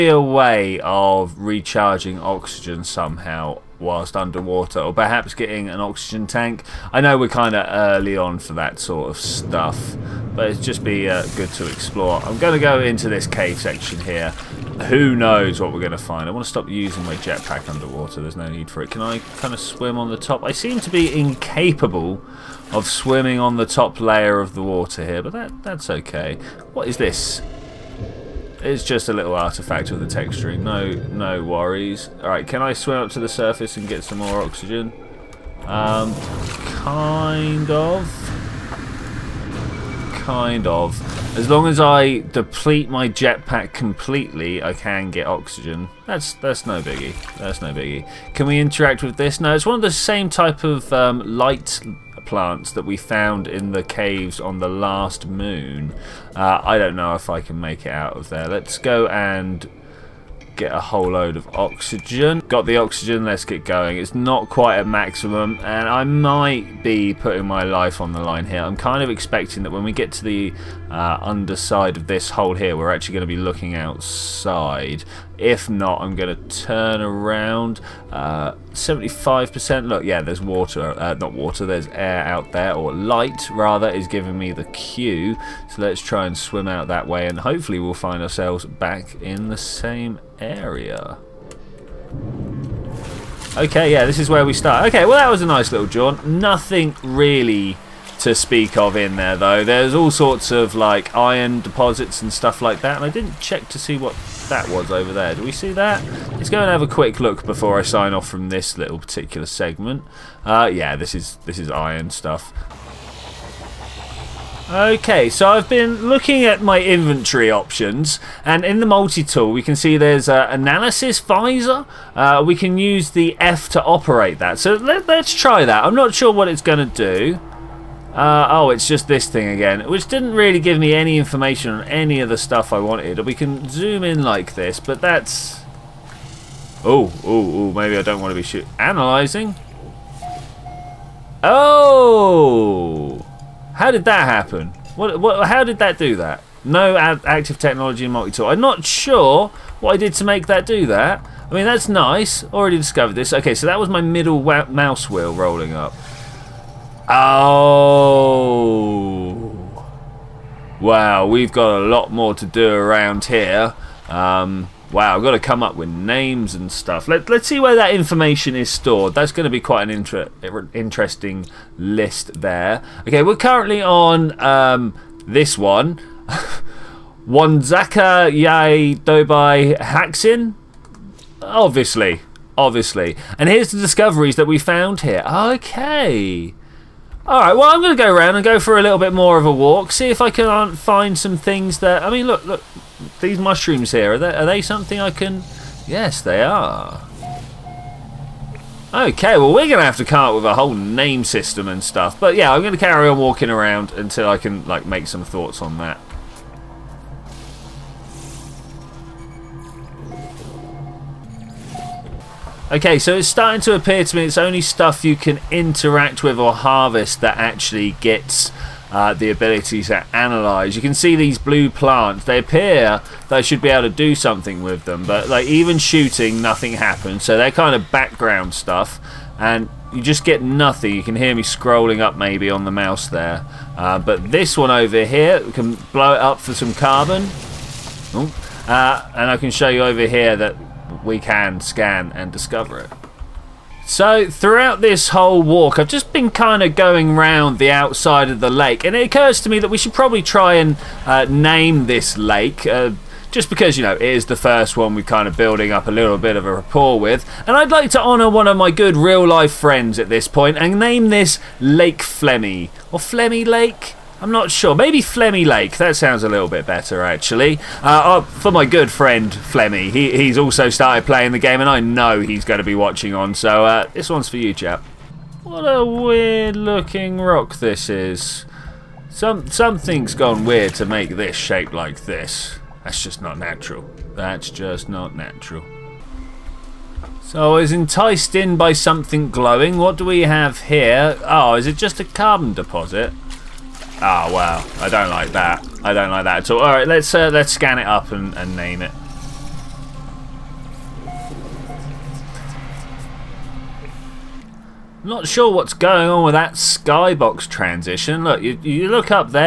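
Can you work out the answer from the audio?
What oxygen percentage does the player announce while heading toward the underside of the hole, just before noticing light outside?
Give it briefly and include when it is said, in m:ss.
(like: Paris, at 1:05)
75%, at 1:18.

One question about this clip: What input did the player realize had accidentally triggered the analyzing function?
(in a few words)
middle mouse wheel.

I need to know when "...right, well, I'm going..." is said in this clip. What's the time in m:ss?
3:07.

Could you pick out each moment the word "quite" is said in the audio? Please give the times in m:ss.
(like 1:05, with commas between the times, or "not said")
1:04, 2:49.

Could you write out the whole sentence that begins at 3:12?
I mean, look, look, these mushrooms here, are they, are they something I can...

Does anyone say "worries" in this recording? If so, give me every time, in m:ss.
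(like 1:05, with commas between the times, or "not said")
0:31.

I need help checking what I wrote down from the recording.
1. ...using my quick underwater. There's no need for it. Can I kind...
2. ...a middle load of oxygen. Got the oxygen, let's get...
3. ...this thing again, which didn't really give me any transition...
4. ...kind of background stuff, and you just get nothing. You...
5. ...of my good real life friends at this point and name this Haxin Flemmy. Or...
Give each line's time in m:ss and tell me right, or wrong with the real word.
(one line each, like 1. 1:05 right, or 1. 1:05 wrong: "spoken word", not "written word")
1. 0:16 wrong: "jetpack", not "quick"
2. 1:00 wrong: "whole", not "middle"
3. 2:09 wrong: "information", not "transition"
4. 3:47 right
5. 4:18 wrong: "Lake", not "Haxin".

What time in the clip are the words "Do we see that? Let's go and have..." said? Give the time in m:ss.
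1:45.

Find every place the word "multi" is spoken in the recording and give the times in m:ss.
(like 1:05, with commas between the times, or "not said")
1:58, 2:28.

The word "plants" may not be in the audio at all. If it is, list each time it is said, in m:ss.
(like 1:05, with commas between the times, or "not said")
0:52, 3:41.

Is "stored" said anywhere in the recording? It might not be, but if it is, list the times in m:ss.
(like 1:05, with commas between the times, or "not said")
2:48.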